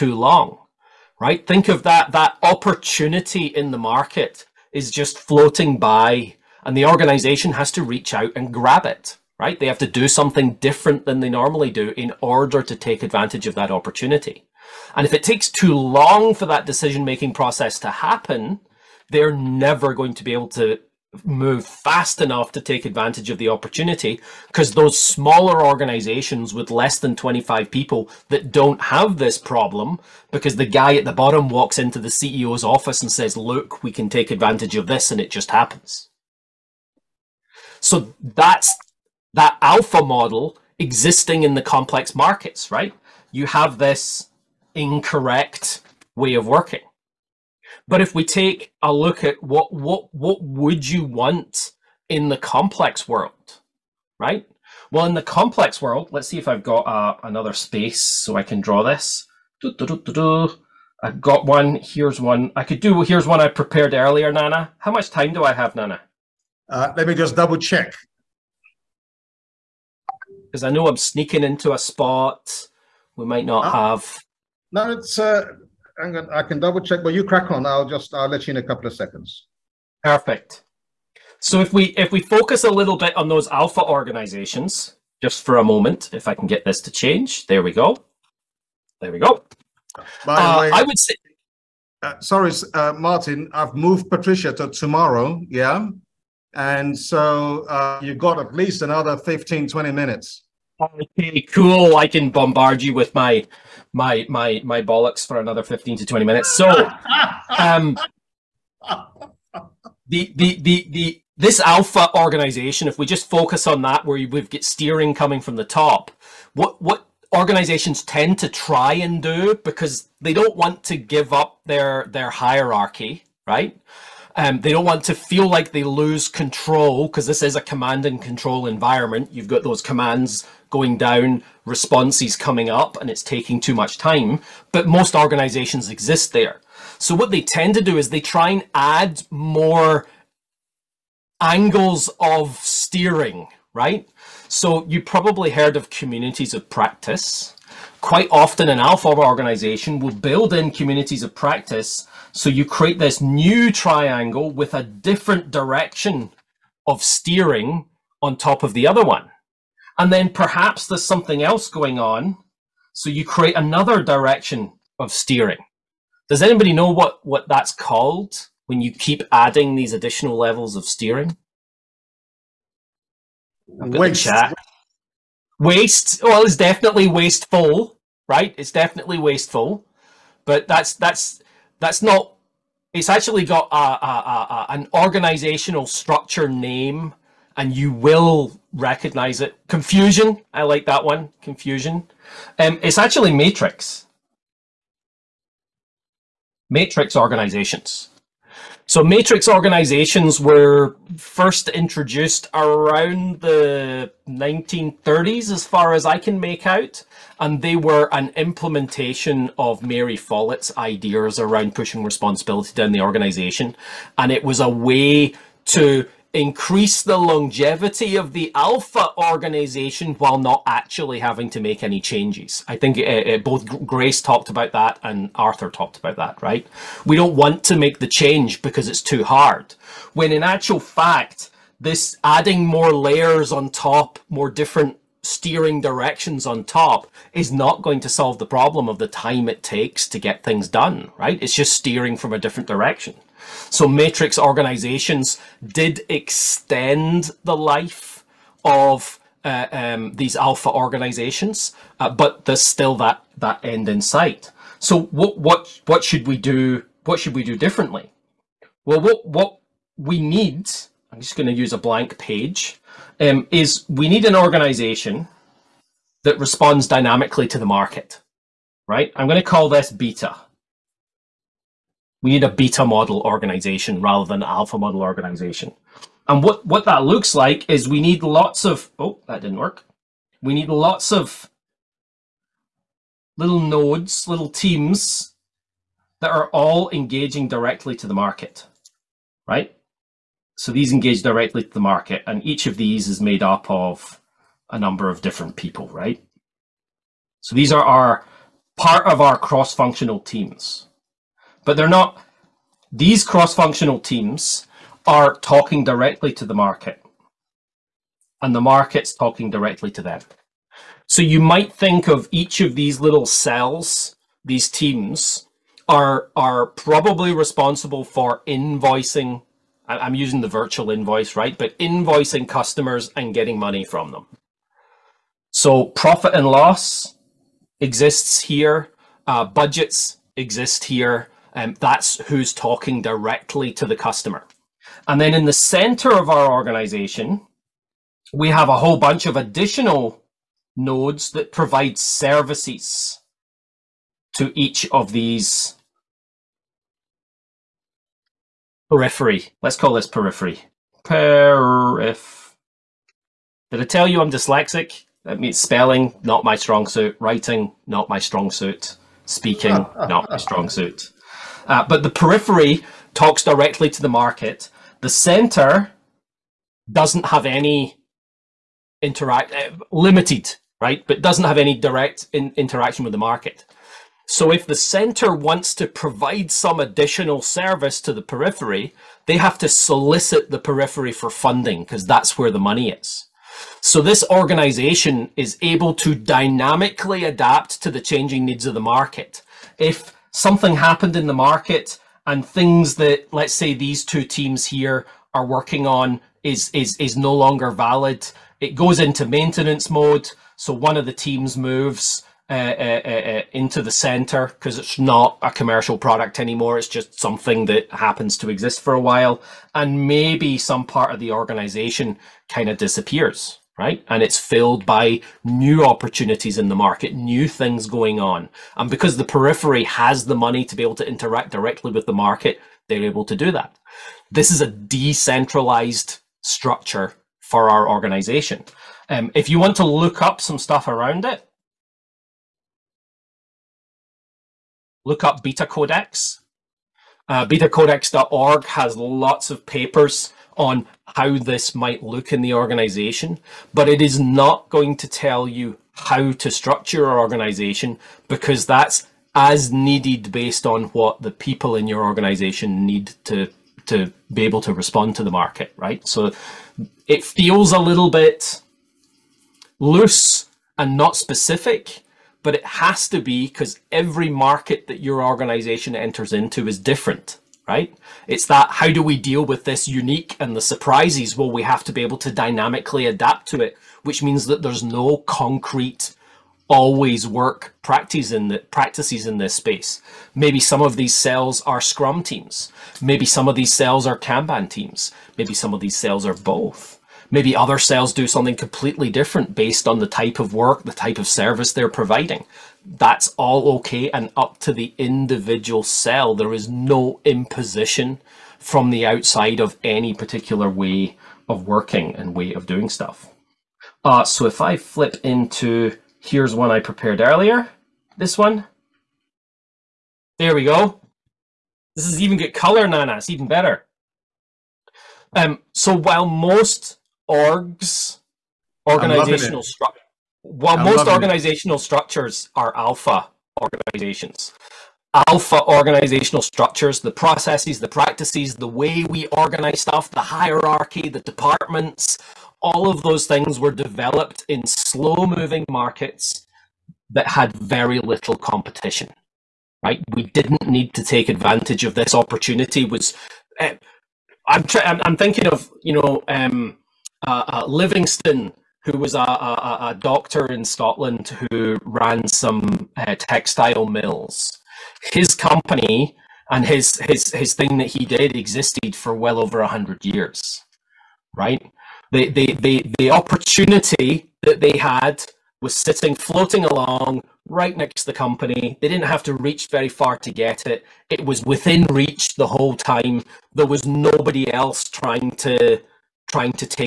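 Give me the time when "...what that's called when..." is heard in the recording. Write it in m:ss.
2:47.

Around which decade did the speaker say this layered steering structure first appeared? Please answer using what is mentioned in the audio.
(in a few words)
1930s.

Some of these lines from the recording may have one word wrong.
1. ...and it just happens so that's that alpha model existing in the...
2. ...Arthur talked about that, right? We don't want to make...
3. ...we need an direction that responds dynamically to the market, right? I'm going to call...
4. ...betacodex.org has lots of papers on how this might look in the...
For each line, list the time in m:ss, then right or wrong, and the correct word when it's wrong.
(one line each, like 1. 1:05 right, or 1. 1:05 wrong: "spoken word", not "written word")
1. 0:35 right
2. 3:45 right
3. 4:23 wrong: "organization", not "direction"
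4. 7:17 right.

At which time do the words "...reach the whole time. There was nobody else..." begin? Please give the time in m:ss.
9:31.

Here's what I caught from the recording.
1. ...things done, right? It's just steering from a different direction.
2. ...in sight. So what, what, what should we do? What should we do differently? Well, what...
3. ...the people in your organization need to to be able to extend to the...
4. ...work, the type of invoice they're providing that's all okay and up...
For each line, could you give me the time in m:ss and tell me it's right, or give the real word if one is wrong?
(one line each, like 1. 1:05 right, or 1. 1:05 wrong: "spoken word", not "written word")
1. 4:00 right
2. 4:13 right
3. 7:31 wrong: "respond", not "extend"
4. 8:10 wrong: "service", not "invoice".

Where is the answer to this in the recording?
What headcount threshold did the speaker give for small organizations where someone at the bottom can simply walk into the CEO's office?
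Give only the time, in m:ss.
0:27.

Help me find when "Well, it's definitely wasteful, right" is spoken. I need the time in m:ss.
2:56.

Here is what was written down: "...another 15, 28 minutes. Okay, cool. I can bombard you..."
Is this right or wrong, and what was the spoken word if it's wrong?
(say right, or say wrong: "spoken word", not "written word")
wrong: "20", not "28".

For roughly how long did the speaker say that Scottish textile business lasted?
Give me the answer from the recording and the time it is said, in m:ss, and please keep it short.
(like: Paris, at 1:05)
over 100 years, at 9:19.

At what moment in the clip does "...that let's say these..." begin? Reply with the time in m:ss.
6:32.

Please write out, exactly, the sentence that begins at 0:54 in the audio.
Well, in the complex world, let's see if I've got uh, another space so I can draw this.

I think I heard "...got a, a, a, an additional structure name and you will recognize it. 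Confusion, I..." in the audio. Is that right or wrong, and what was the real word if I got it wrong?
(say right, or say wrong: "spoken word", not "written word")
wrong: "organizational", not "additional".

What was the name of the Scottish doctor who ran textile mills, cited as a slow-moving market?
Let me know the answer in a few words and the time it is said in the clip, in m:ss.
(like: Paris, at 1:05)
Livingston, at 9:07.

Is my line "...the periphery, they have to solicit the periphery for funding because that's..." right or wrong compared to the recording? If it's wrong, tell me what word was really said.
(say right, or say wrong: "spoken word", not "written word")
right.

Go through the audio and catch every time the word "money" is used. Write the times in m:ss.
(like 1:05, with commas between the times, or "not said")
5:23, 6:22, 7:00.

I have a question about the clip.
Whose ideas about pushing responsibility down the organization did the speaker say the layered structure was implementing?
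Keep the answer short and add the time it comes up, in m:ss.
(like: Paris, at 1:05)
Mary Follett, at 3:29.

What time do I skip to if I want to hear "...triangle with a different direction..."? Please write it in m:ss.
2:33.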